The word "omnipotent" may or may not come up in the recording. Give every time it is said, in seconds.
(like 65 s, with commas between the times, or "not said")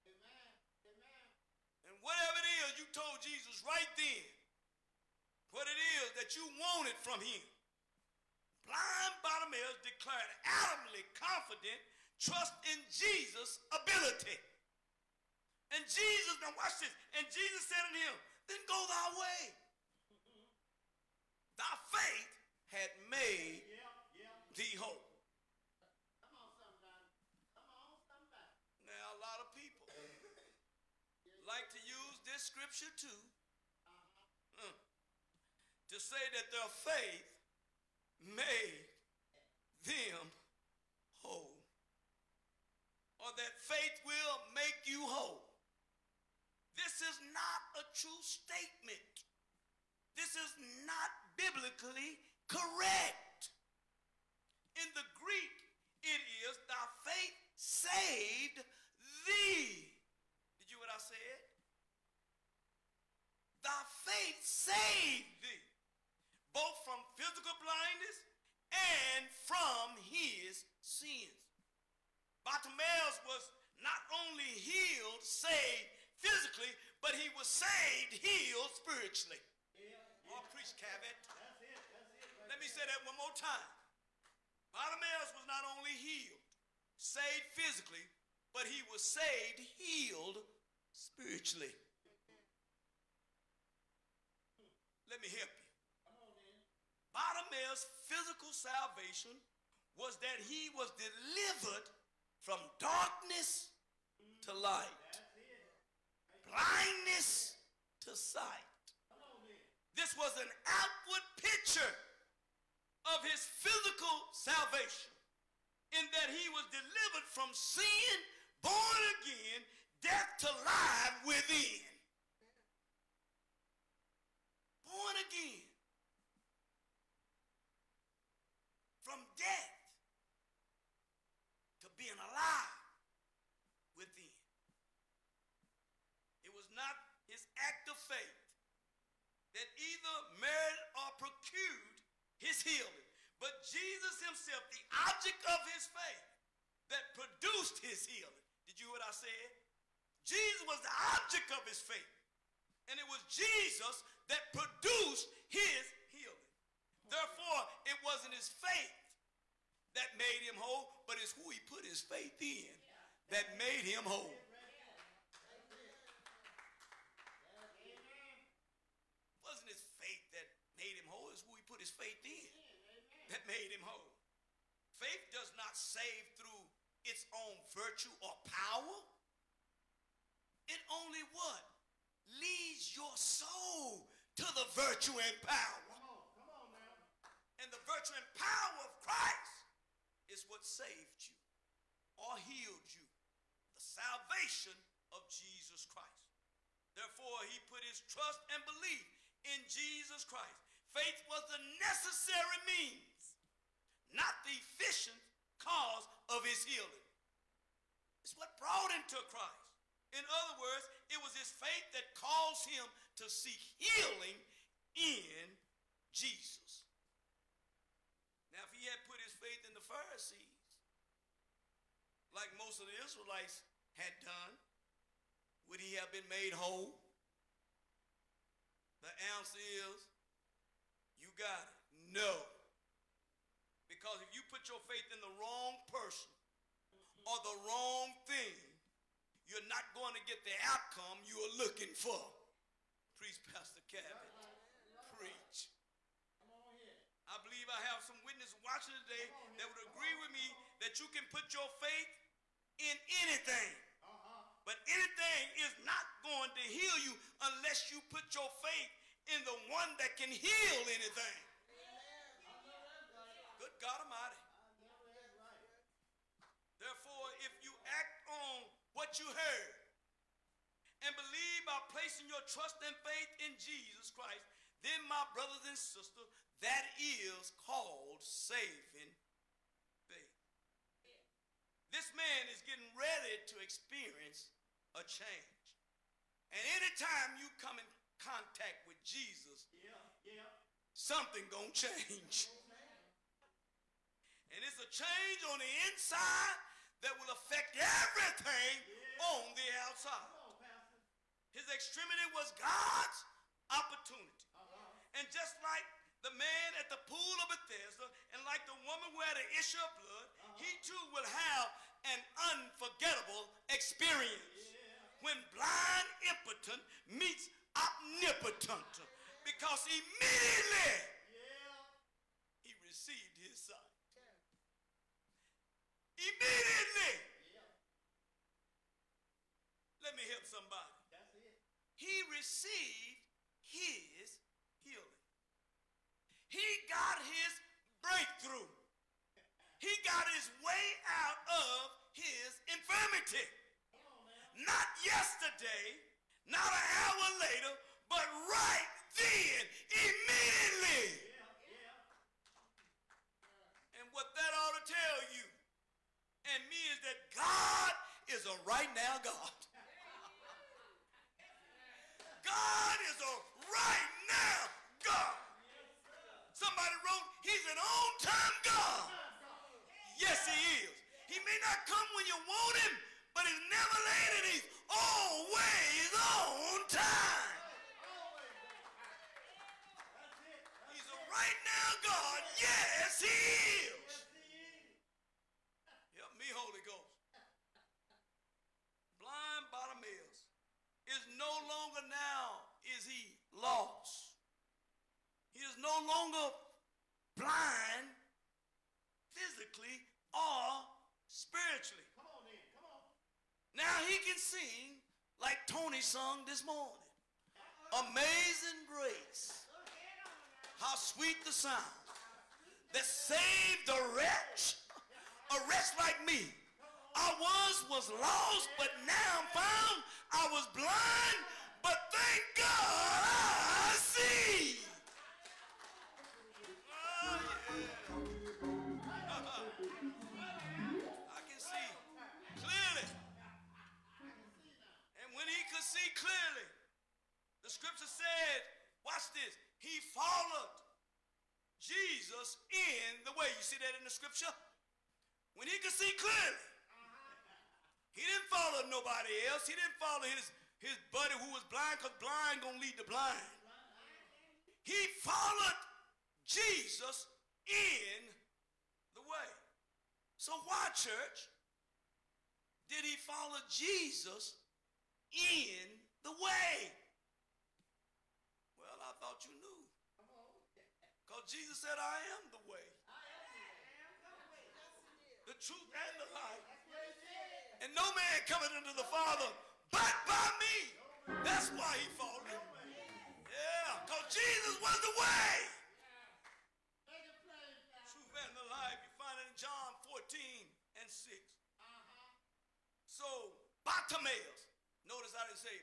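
317 s.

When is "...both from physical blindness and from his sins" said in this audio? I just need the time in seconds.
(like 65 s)
66 s.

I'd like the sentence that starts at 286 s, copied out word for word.
And anytime you come in contact with Jesus, yeah, yeah.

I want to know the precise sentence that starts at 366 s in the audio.
Somebody wrote, He's an on time God.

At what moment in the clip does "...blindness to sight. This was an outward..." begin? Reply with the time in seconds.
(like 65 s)
106 s.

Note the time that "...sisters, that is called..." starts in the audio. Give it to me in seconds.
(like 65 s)
275 s.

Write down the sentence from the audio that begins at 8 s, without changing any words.
Blind Bartimaeus declared adamantly confident trust in Jesus' ability.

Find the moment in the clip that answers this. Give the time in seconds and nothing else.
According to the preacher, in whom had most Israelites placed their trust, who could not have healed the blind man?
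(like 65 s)
219 s.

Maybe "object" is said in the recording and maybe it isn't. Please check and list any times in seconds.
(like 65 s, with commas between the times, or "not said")
145 s, 151 s.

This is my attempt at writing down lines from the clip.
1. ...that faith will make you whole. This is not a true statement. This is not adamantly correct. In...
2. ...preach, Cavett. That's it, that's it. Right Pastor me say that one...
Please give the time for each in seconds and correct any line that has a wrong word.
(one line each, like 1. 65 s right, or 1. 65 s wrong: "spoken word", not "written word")
1. 43 s wrong: "biblically", not "adamantly"
2. 80 s wrong: "Let", not "Pastor".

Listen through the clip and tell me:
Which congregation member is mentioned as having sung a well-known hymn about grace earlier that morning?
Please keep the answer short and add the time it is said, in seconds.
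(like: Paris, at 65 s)
Tony, at 405 s.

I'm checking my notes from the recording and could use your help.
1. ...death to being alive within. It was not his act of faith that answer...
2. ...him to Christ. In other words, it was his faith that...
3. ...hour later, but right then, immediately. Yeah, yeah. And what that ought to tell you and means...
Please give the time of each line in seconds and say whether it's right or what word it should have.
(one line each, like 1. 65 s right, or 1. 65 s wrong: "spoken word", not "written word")
1. 129 s wrong: "either", not "answer"
2. 208 s right
3. 347 s right.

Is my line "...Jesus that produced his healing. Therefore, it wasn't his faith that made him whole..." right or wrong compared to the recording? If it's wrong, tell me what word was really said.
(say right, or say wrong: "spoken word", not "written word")
right.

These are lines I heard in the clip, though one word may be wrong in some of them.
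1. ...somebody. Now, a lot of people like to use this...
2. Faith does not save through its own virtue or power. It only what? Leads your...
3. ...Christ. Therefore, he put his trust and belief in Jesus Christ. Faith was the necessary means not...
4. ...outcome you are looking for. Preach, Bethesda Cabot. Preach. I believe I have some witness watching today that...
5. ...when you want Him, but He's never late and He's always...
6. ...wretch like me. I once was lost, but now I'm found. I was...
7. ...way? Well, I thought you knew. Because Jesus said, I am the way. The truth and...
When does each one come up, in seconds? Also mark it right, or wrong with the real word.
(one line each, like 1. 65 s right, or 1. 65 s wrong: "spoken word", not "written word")
1. 28 s right
2. 174 s right
3. 195 s right
4. 240 s wrong: "Pastor", not "Bethesda"
5. 372 s right
6. 415 s right
7. 466 s right.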